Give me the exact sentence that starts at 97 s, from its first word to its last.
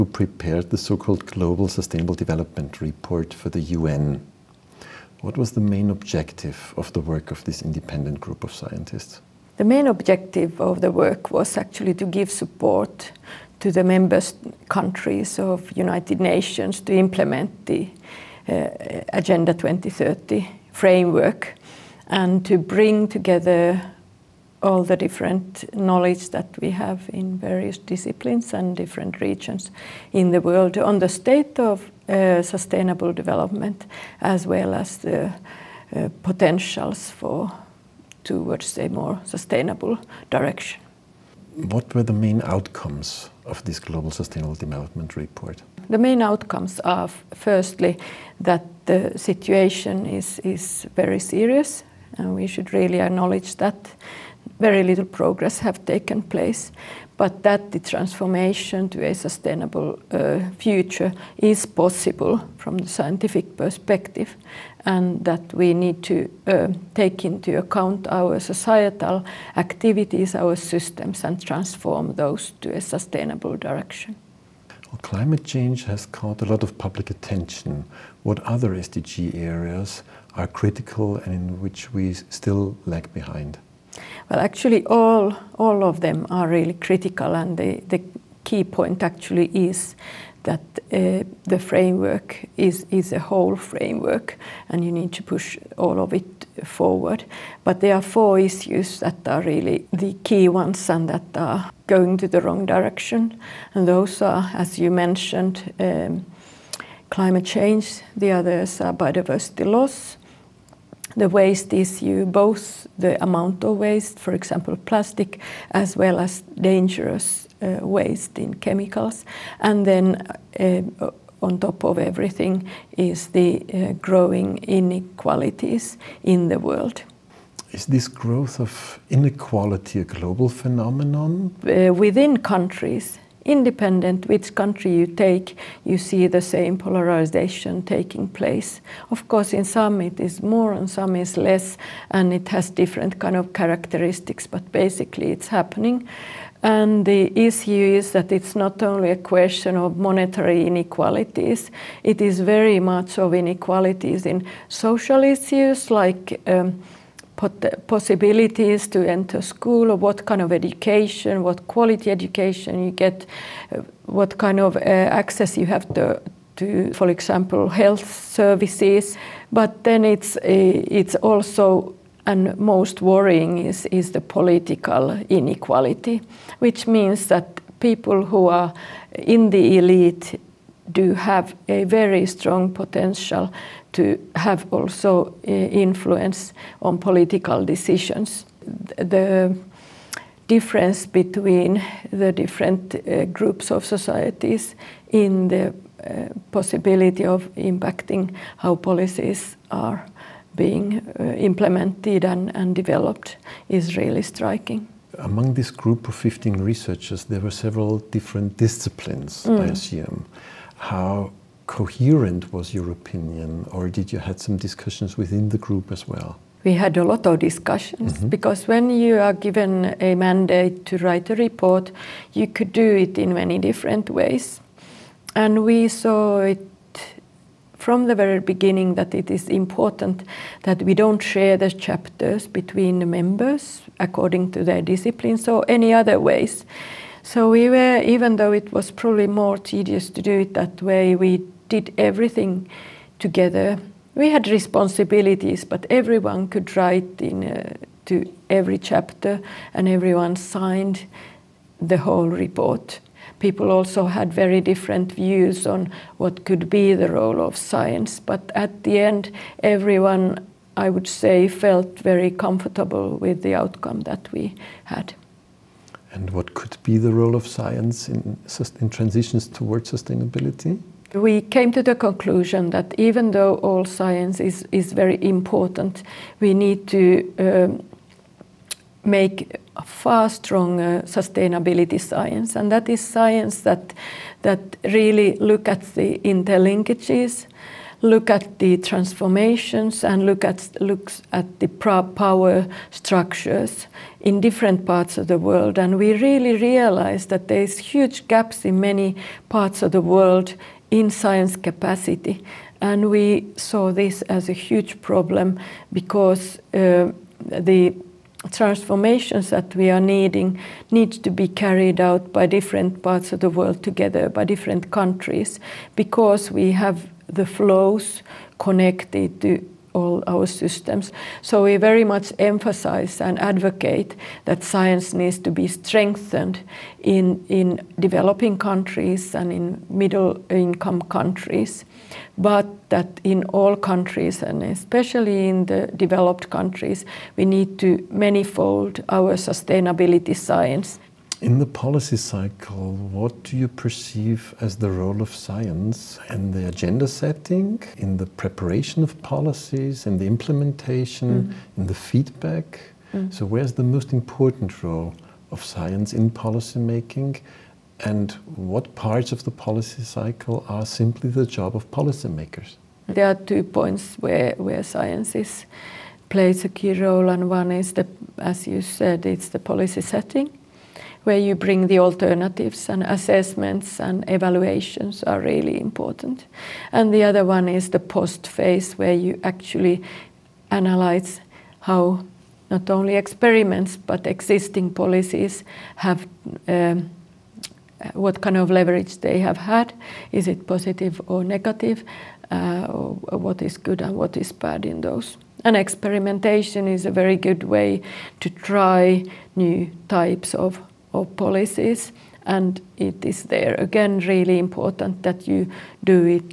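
But there are four issues that are really the key ones and that are going to the wrong direction.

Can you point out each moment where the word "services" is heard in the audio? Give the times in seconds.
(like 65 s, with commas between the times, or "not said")
168 s.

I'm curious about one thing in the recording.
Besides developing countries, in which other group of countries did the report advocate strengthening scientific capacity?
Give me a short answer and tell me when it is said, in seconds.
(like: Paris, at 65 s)
middle income countries, at 329 s.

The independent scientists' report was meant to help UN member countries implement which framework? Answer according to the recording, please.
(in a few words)
Agenda 2030.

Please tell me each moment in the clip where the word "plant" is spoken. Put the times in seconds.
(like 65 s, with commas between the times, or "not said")
not said.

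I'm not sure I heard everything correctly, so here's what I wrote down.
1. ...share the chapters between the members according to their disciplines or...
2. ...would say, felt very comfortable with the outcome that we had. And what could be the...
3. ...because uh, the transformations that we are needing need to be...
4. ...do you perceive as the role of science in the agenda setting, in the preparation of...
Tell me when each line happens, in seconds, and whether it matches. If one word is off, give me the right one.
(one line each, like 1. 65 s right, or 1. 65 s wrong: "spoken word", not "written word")
1. 231 s right
2. 260 s right
3. 305 s right
4. 343 s right.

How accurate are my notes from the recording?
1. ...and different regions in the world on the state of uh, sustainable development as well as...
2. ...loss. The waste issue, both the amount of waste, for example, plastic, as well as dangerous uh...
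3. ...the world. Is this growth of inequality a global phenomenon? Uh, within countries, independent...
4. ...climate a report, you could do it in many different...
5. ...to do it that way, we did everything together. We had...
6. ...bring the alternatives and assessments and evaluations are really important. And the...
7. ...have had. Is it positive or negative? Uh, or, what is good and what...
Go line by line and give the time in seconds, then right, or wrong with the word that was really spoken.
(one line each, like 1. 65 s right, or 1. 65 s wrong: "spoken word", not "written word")
1. 28 s right
2. 109 s right
3. 126 s right
4. 220 s wrong: "write", not "climate"
5. 240 s right
6. 371 s right
7. 389 s right.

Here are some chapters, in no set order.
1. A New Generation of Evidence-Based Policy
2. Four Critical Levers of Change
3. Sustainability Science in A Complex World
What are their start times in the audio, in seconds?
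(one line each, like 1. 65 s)
1. 340 s
2. 74 s
3. 265 s.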